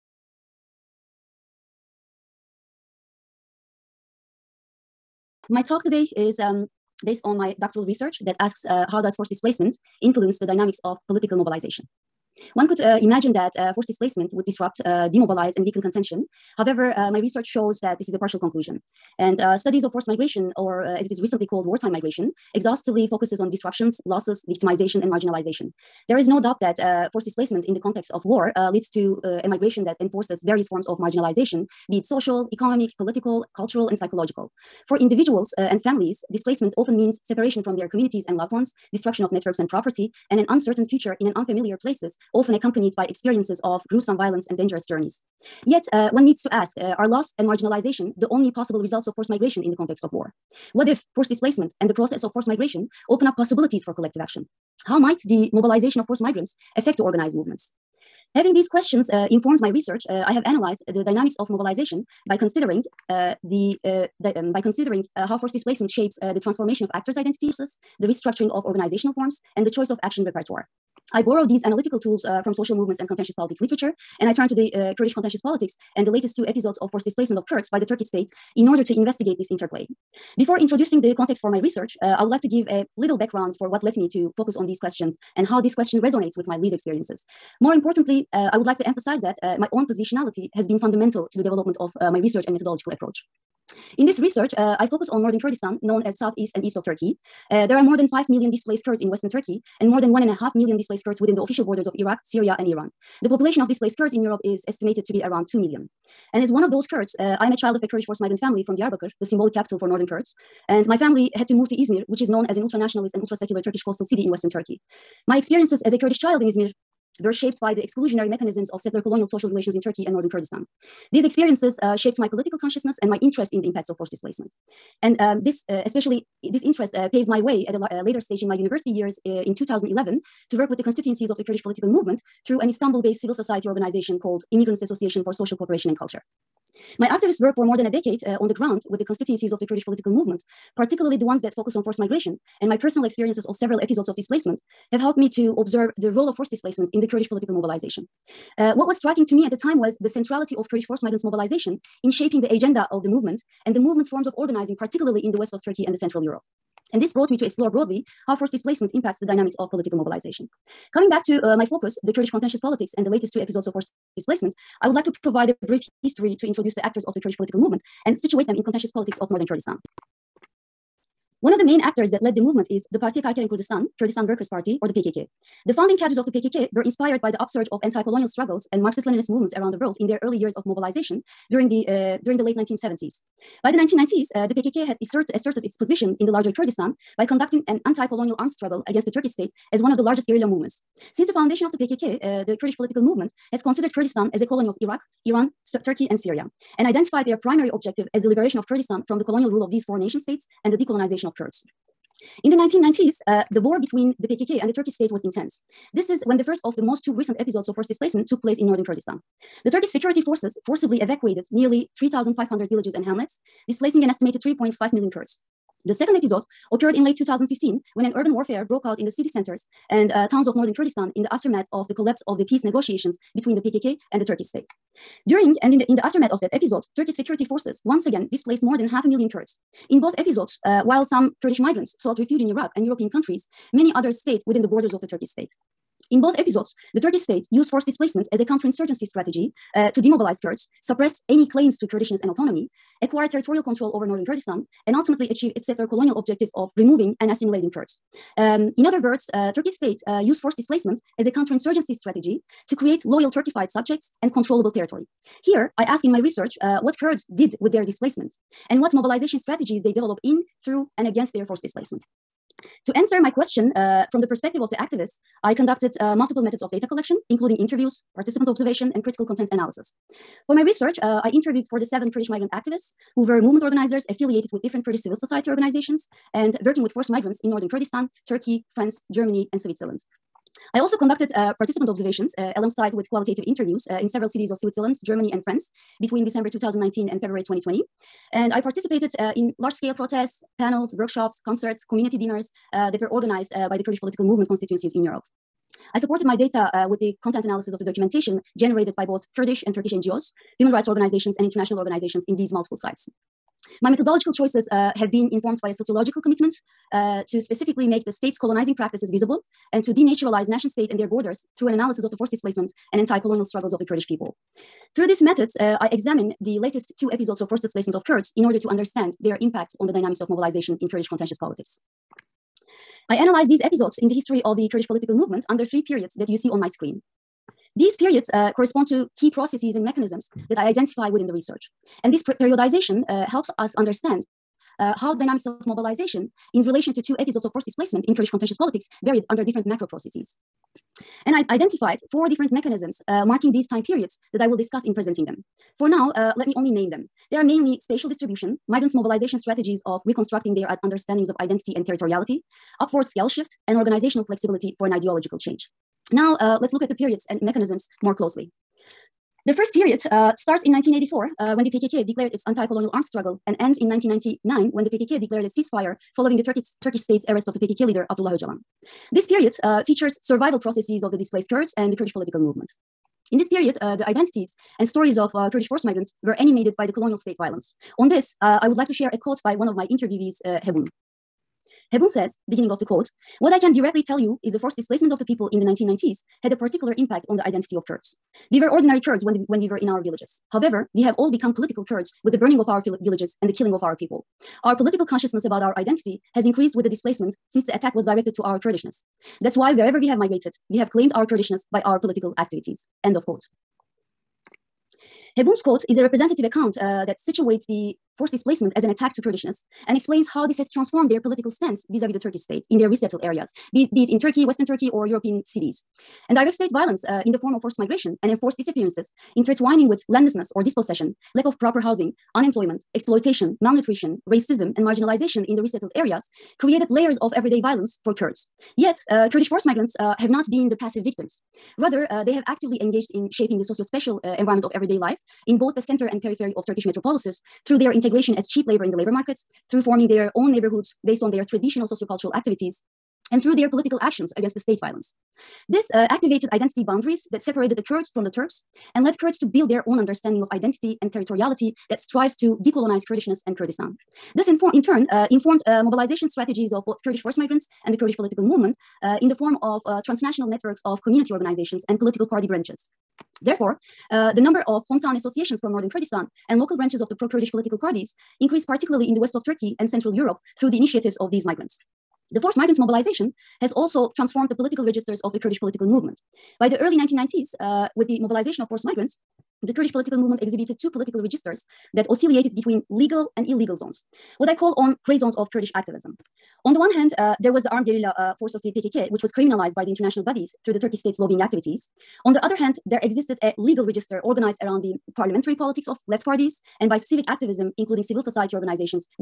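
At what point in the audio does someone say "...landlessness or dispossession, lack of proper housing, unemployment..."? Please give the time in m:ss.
7:00.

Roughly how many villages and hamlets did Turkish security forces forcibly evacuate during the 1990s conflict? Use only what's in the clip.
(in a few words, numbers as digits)
3,500.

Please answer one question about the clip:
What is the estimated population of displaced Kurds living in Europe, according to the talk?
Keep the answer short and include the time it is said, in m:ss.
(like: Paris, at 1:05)
2 million, at 1:45.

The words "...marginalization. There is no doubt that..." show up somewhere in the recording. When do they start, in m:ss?
0:25.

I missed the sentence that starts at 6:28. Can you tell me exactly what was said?
We were ordinary Kurds when, the, when we were in our villages.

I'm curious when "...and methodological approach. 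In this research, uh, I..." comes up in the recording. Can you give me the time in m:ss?
1:32.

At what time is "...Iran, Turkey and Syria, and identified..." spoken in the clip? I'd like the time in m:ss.
3:15.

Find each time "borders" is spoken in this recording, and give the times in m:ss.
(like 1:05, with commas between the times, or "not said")
1:41, 3:54, 5:11.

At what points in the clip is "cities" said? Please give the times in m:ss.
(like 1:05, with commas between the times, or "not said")
4:44, 6:55.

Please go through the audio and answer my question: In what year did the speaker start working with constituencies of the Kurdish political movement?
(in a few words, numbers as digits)
2011.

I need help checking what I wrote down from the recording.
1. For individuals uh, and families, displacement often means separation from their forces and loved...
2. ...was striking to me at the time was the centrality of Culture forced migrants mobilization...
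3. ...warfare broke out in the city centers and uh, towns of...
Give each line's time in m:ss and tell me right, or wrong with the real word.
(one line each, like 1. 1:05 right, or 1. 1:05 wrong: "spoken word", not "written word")
1. 0:34 wrong: "communities", not "forces"
2. 2:28 wrong: "Kurdish", not "Culture"
3. 3:38 right.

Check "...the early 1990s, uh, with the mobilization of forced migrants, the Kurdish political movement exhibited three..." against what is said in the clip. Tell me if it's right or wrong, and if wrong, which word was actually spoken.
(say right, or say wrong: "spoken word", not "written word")
wrong: "two", not "three".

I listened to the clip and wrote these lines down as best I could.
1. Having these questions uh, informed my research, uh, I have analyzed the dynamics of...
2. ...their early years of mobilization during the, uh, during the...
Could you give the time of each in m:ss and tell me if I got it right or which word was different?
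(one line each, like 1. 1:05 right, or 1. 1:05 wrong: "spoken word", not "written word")
1. 0:58 right
2. 3:00 right.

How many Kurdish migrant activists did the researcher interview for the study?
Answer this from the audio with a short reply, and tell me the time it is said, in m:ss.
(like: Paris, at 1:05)
47, at 4:31.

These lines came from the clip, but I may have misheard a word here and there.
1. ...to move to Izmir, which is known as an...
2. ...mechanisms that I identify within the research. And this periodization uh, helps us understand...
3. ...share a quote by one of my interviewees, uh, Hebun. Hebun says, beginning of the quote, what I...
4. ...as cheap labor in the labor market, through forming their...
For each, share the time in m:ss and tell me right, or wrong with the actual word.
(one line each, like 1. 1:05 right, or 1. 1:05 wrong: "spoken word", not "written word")
1. 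1:51 right
2. 5:29 right
3. 6:18 right
4. 7:18 right.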